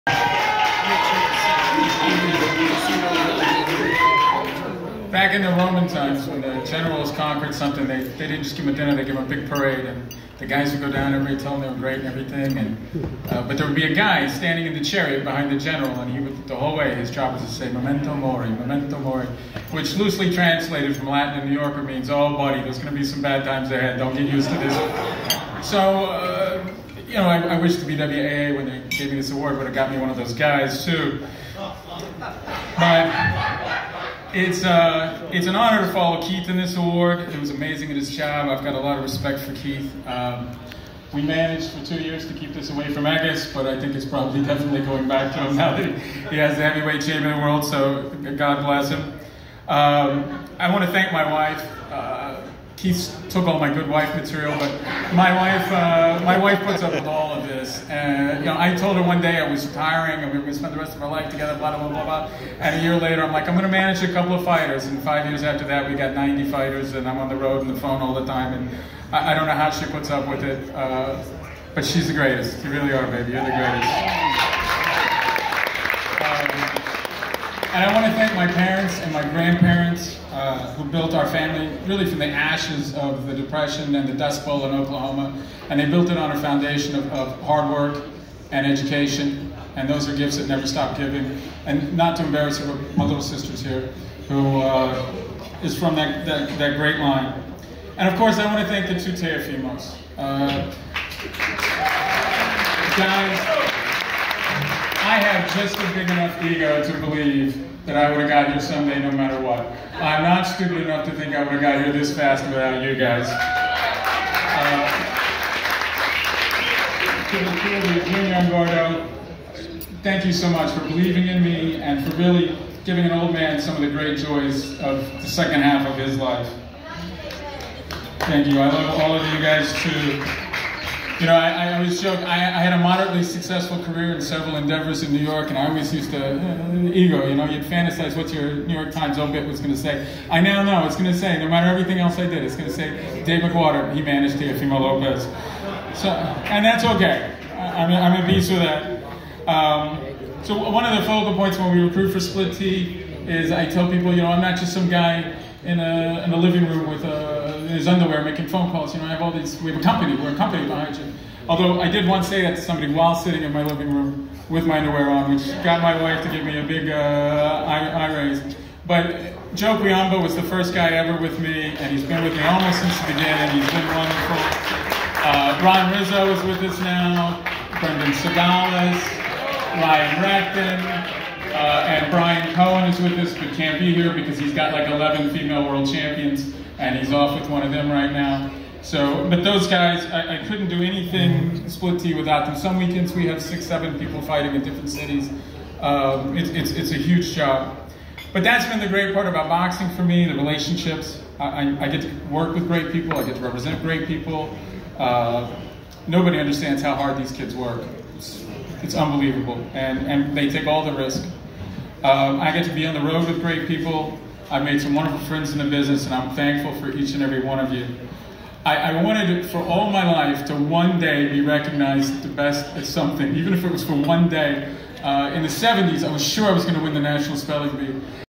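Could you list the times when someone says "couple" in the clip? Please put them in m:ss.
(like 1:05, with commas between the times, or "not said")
1:04.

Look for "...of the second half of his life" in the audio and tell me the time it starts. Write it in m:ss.
2:04.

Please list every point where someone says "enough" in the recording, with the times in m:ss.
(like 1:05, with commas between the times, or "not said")
1:46, 1:50.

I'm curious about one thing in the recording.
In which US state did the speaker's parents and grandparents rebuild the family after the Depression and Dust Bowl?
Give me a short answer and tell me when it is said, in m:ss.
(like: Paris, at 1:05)
Oklahoma, at 1:24.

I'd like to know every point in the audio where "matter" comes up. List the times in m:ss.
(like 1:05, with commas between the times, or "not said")
1:49, 2:21.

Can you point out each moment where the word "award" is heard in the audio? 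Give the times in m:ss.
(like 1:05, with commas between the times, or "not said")
0:29, 0:36.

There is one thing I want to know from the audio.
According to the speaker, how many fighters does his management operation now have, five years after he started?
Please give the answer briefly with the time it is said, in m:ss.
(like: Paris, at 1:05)
90, at 1:06.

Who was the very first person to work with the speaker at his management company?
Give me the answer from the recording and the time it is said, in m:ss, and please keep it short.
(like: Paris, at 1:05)
Joe Guiamba, at 2:49.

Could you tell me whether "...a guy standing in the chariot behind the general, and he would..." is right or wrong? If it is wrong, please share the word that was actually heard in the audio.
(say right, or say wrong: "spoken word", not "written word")
right.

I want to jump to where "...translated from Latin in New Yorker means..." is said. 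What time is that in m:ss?
0:20.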